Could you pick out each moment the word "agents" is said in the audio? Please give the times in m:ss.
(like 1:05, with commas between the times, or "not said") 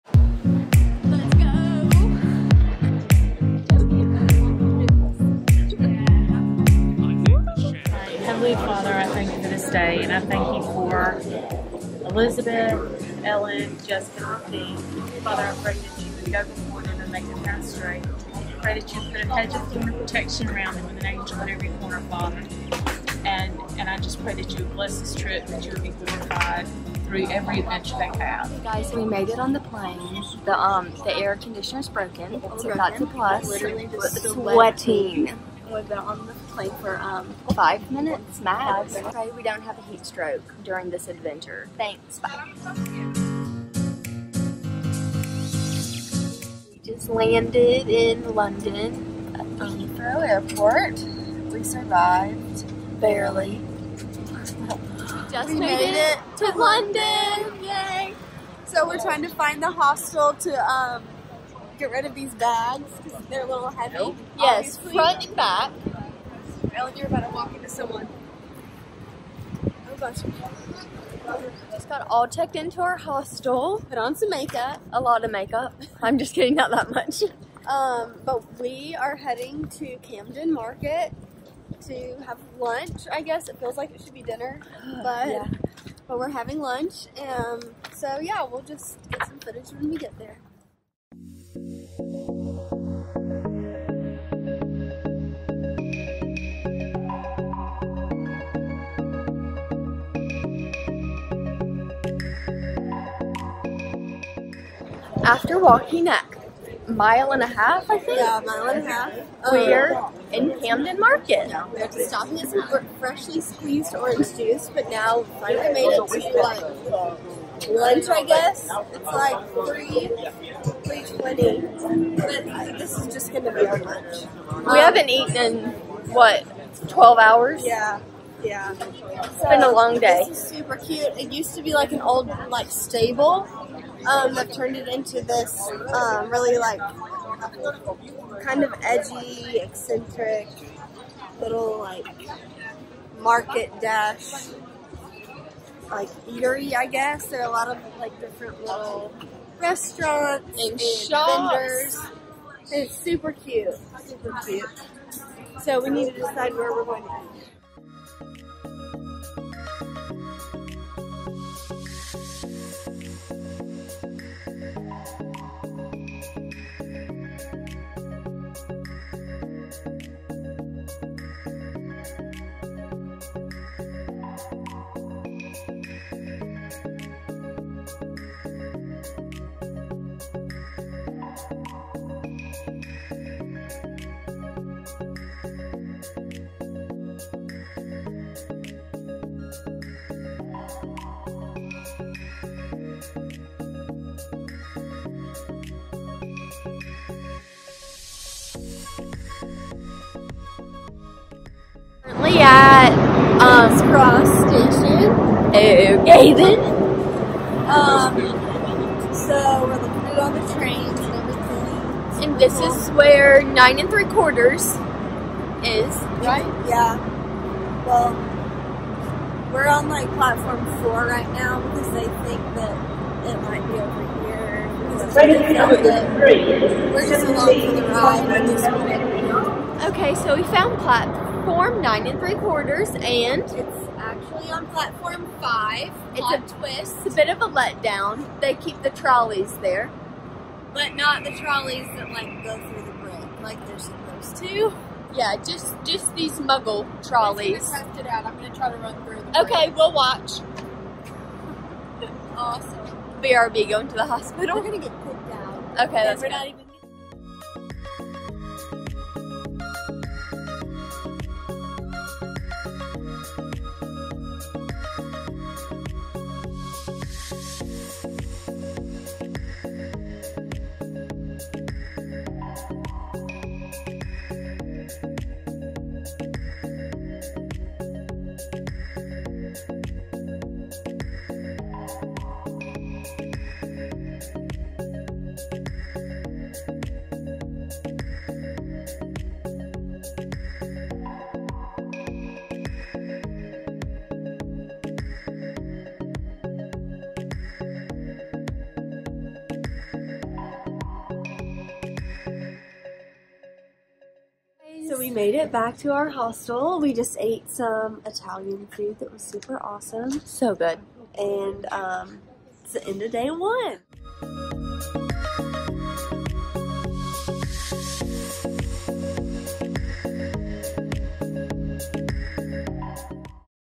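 not said.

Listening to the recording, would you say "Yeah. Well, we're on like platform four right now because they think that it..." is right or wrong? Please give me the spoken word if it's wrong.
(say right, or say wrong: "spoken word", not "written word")
right.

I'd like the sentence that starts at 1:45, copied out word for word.
After walking a mile and a half, I think.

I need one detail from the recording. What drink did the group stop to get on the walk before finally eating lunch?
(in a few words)
freshly squeezed orange juice.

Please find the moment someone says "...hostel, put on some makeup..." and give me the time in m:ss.
1:12.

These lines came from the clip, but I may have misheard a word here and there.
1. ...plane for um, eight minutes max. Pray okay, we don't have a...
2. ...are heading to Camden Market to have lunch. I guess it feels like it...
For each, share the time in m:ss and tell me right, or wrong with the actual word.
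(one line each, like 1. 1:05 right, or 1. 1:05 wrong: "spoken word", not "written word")
1. 0:36 wrong: "five", not "eight"
2. 1:18 right.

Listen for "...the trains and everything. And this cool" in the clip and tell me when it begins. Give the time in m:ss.
3:30.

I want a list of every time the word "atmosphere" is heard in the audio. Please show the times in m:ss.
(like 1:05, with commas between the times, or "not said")
not said.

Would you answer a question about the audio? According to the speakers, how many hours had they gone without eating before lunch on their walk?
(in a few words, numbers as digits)
12.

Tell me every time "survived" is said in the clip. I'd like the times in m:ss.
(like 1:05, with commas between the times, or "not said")
0:51.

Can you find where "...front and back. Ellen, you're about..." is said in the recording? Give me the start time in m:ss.
1:04.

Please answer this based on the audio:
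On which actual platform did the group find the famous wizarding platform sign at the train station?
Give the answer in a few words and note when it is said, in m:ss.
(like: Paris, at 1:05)
platform 5, at 3:54.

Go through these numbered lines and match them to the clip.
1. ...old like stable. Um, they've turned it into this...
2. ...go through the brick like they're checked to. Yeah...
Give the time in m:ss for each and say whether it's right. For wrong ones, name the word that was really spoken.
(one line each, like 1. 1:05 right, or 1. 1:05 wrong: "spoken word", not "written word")
1. 2:12 right
2. 4:02 wrong: "supposed", not "checked".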